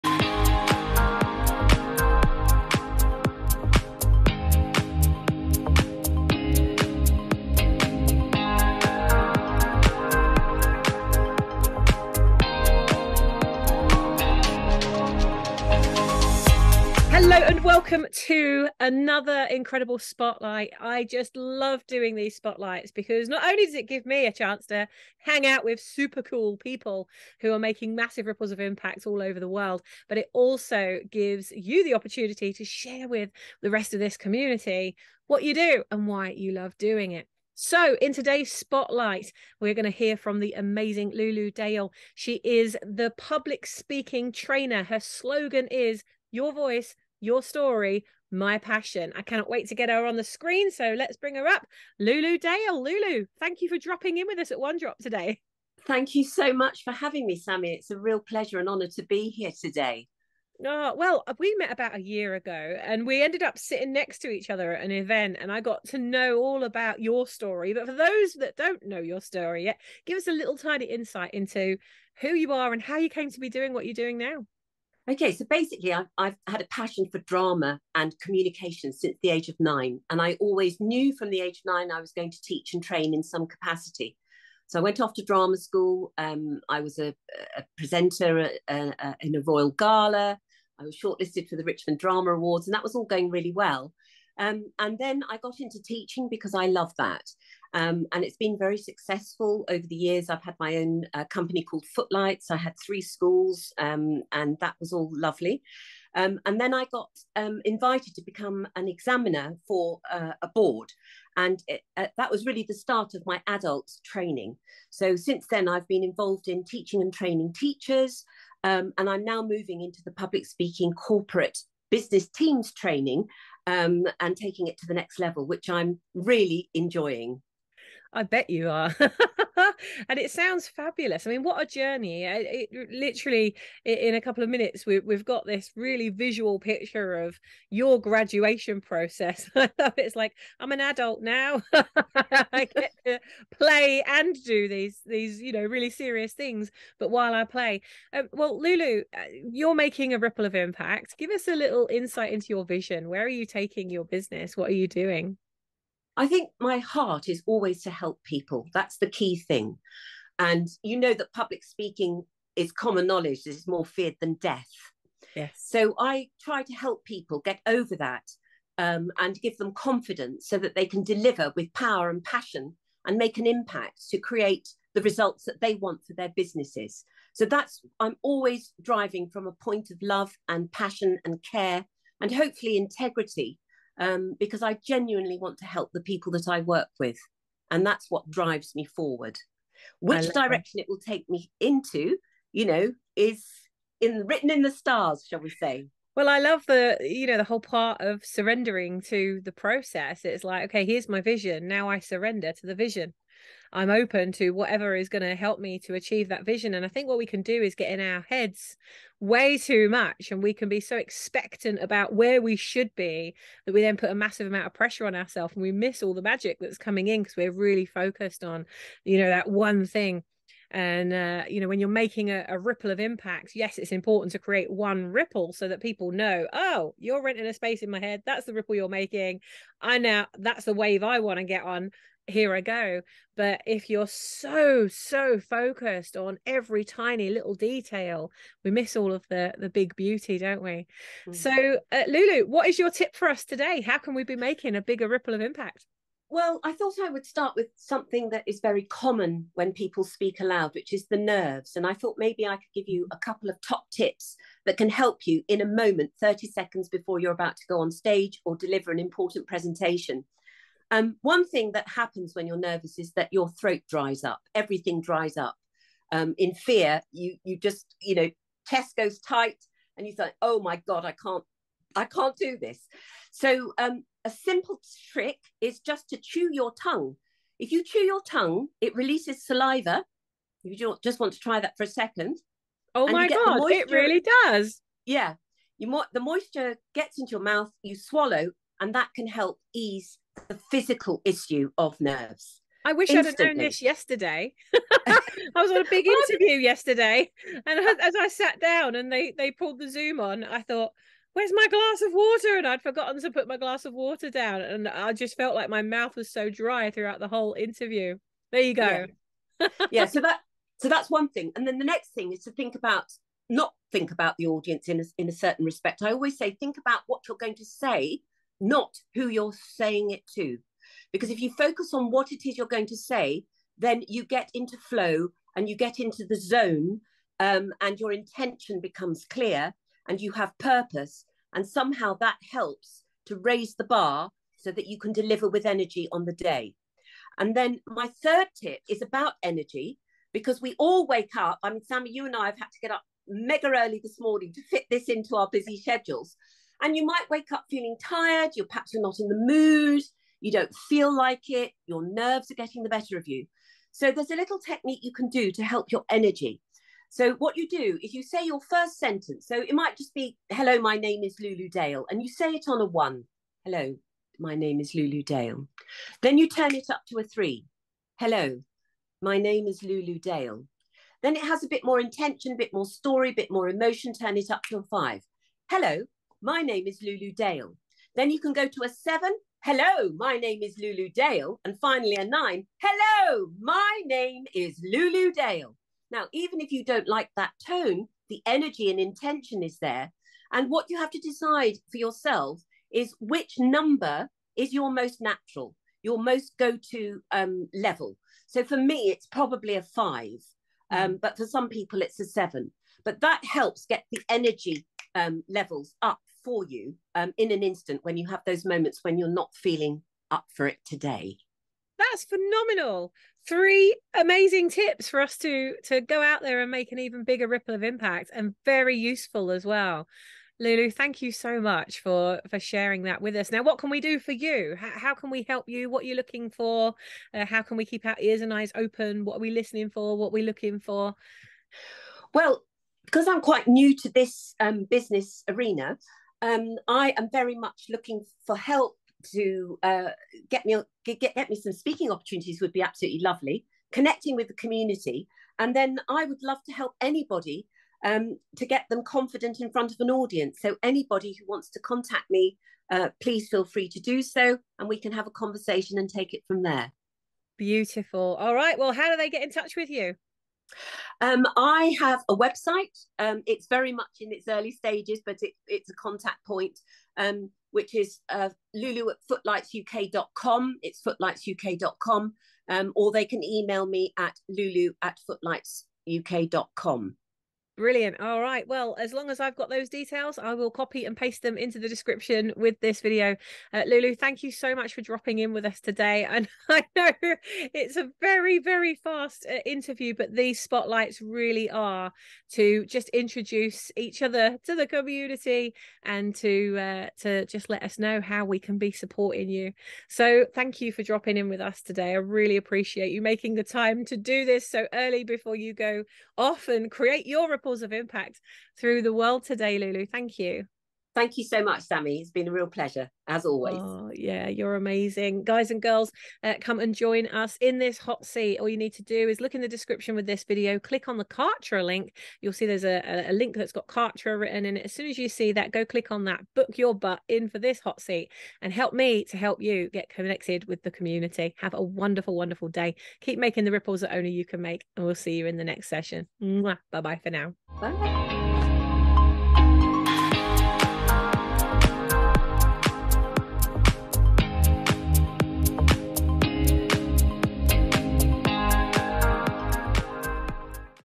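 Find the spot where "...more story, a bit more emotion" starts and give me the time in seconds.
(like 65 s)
372 s.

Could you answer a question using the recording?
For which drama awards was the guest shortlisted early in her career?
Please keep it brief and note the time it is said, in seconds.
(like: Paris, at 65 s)
Richmond Drama Awards, at 91 s.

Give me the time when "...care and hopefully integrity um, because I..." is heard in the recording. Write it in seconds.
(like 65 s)
181 s.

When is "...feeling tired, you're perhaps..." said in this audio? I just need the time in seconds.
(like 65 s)
347 s.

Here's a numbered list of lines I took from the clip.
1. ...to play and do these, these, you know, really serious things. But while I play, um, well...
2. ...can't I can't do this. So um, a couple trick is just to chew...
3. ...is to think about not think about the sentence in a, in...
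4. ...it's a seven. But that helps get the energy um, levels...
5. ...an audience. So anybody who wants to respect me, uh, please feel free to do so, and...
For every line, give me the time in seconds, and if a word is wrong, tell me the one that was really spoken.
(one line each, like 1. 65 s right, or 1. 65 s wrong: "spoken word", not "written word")
1. 143 s right
2. 271 s wrong: "simple", not "couple"
3. 312 s wrong: "audience", not "sentence"
4. 402 s right
5. 449 s wrong: "contact", not "respect".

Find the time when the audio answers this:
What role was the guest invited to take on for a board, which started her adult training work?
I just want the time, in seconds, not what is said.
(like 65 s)
108 s.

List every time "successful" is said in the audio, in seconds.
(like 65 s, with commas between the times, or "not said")
98 s.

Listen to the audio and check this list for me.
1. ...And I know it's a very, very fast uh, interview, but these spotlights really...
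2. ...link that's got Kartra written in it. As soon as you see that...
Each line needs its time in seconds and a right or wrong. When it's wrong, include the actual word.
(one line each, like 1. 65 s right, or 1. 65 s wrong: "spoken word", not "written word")
1. 486 s right
2. 523 s right.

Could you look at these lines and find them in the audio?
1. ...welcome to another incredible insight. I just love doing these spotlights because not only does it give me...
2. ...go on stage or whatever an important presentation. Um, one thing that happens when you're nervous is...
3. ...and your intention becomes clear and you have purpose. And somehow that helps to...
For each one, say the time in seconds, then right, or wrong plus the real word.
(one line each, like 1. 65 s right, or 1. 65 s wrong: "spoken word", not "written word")
1. 17 s wrong: "spotlight", not "insight"
2. 257 s wrong: "deliver", not "whatever"
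3. 327 s right.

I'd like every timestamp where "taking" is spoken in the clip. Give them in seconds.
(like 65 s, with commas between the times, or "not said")
124 s, 153 s.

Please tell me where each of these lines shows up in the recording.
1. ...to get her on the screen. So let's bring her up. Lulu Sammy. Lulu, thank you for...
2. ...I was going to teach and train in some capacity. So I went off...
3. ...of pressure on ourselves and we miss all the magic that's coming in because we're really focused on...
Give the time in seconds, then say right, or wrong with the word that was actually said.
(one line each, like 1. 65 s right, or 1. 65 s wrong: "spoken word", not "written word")
1. 49 s wrong: "Dale", not "Sammy"
2. 81 s right
3. 214 s right.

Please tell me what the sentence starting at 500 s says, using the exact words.
So thank you for dropping in with us today.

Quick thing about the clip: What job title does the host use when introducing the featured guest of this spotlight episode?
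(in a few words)
public speaking trainer.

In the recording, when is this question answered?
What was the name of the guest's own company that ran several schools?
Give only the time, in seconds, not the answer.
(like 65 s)
101 s.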